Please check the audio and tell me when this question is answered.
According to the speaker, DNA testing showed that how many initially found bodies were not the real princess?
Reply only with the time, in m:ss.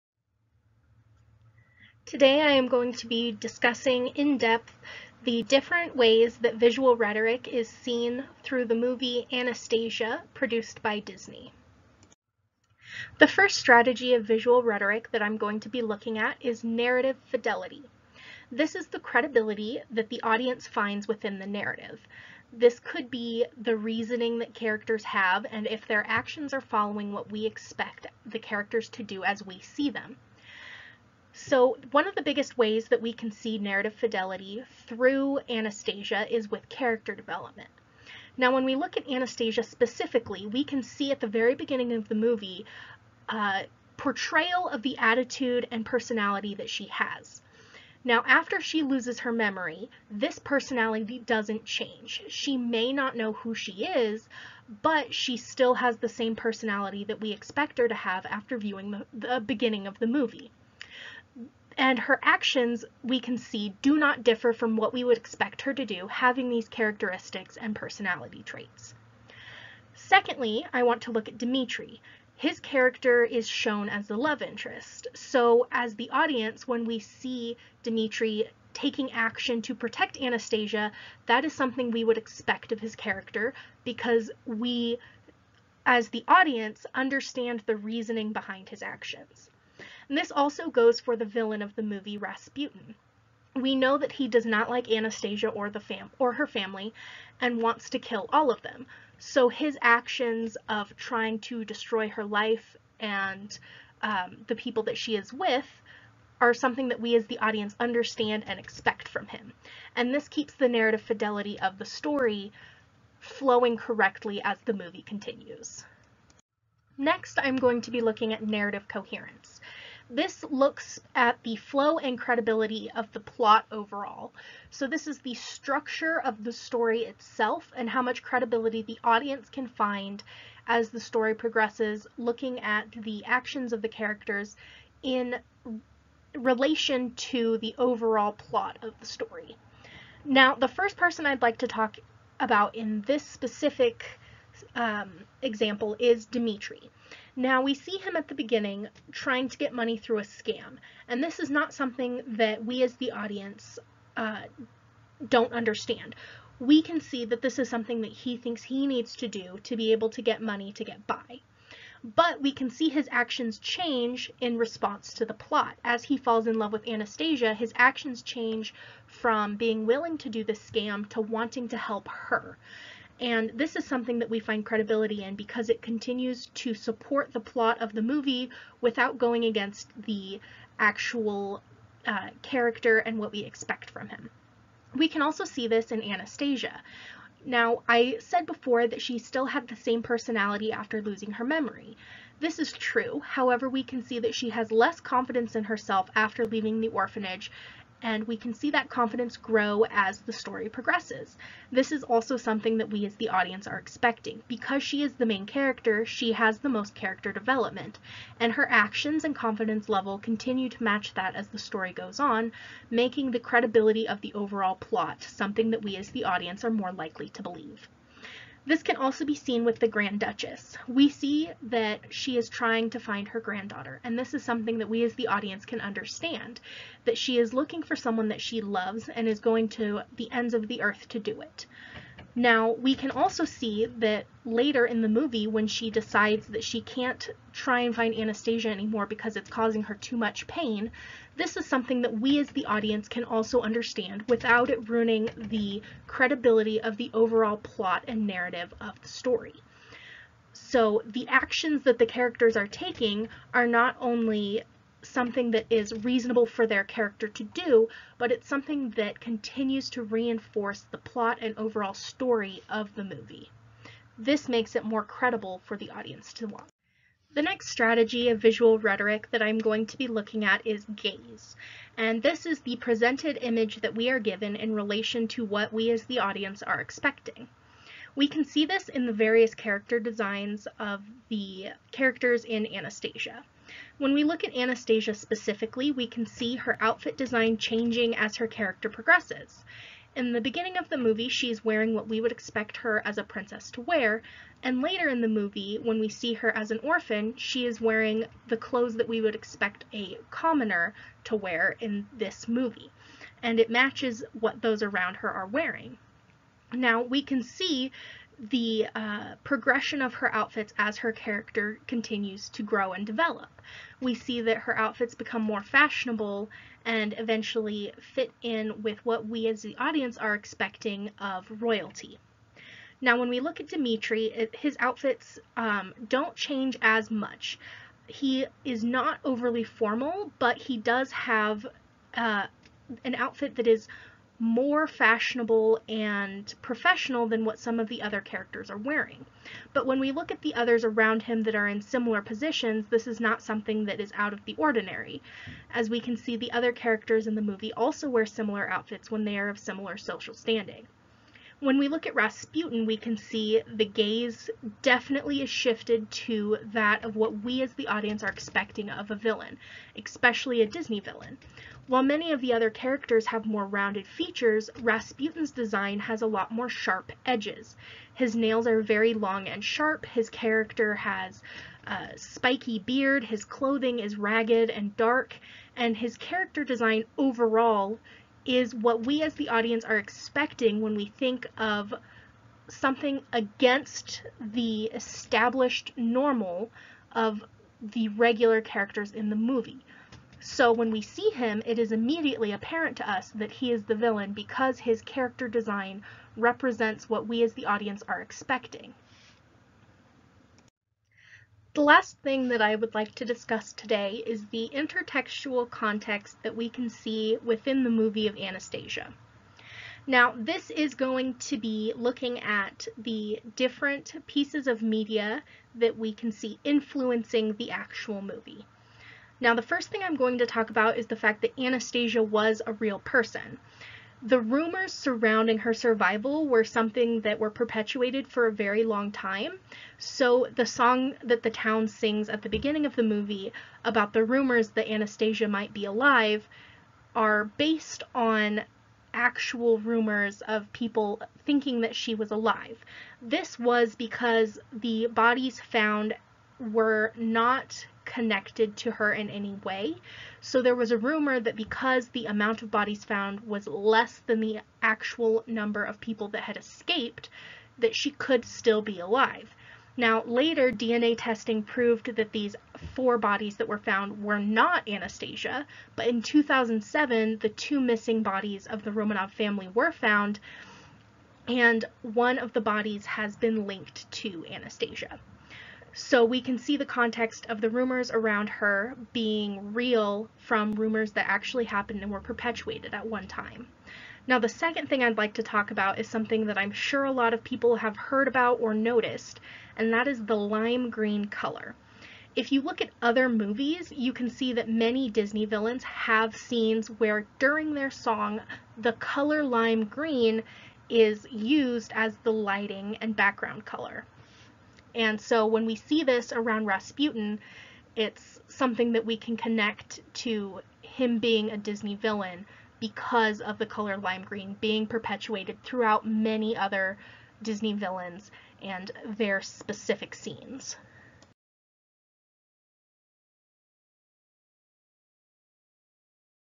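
7:42.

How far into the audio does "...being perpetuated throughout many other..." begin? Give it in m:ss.
8:34.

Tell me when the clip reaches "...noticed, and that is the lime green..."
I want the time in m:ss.
8:08.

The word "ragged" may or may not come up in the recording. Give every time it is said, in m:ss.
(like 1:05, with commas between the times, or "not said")
6:14.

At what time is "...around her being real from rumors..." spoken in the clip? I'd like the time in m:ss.
7:58.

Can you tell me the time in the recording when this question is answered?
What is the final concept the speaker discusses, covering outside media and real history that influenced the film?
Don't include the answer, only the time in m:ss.
6:44.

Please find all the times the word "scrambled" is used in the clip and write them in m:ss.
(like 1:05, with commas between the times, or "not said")
not said.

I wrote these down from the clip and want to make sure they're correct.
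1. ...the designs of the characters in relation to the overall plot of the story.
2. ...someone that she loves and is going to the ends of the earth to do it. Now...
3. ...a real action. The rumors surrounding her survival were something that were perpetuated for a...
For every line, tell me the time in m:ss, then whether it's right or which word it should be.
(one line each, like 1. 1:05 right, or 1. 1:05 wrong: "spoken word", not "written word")
1. 2:12 wrong: "actions", not "designs"
2. 3:47 right
3. 7:02 wrong: "person", not "action".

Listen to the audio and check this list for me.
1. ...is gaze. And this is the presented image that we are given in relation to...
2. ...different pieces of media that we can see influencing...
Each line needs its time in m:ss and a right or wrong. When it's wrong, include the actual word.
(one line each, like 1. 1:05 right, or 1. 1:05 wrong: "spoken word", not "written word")
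1. 4:30 right
2. 6:53 right.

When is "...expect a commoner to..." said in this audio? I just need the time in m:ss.
4:59.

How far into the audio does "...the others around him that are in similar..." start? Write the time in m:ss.
5:40.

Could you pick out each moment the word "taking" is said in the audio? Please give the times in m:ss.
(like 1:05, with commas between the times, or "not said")
1:18, 4:12.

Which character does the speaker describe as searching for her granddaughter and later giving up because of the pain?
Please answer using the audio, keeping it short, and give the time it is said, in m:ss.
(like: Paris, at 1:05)
the Grand Duchess, at 3:39.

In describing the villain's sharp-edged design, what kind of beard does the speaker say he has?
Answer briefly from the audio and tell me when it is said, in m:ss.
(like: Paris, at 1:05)
spiky, at 6:12.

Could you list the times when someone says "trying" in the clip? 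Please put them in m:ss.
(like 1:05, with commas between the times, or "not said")
1:40, 2:29, 3:42.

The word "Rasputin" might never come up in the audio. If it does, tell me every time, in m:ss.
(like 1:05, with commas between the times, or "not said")
1:32, 5:52, 6:04, 8:26.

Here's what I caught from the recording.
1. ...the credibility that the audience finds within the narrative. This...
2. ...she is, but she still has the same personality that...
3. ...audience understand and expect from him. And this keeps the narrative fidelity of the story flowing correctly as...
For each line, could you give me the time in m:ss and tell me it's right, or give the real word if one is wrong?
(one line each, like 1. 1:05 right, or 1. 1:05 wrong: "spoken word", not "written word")
1. 0:18 right
2. 0:53 right
3. 1:47 right.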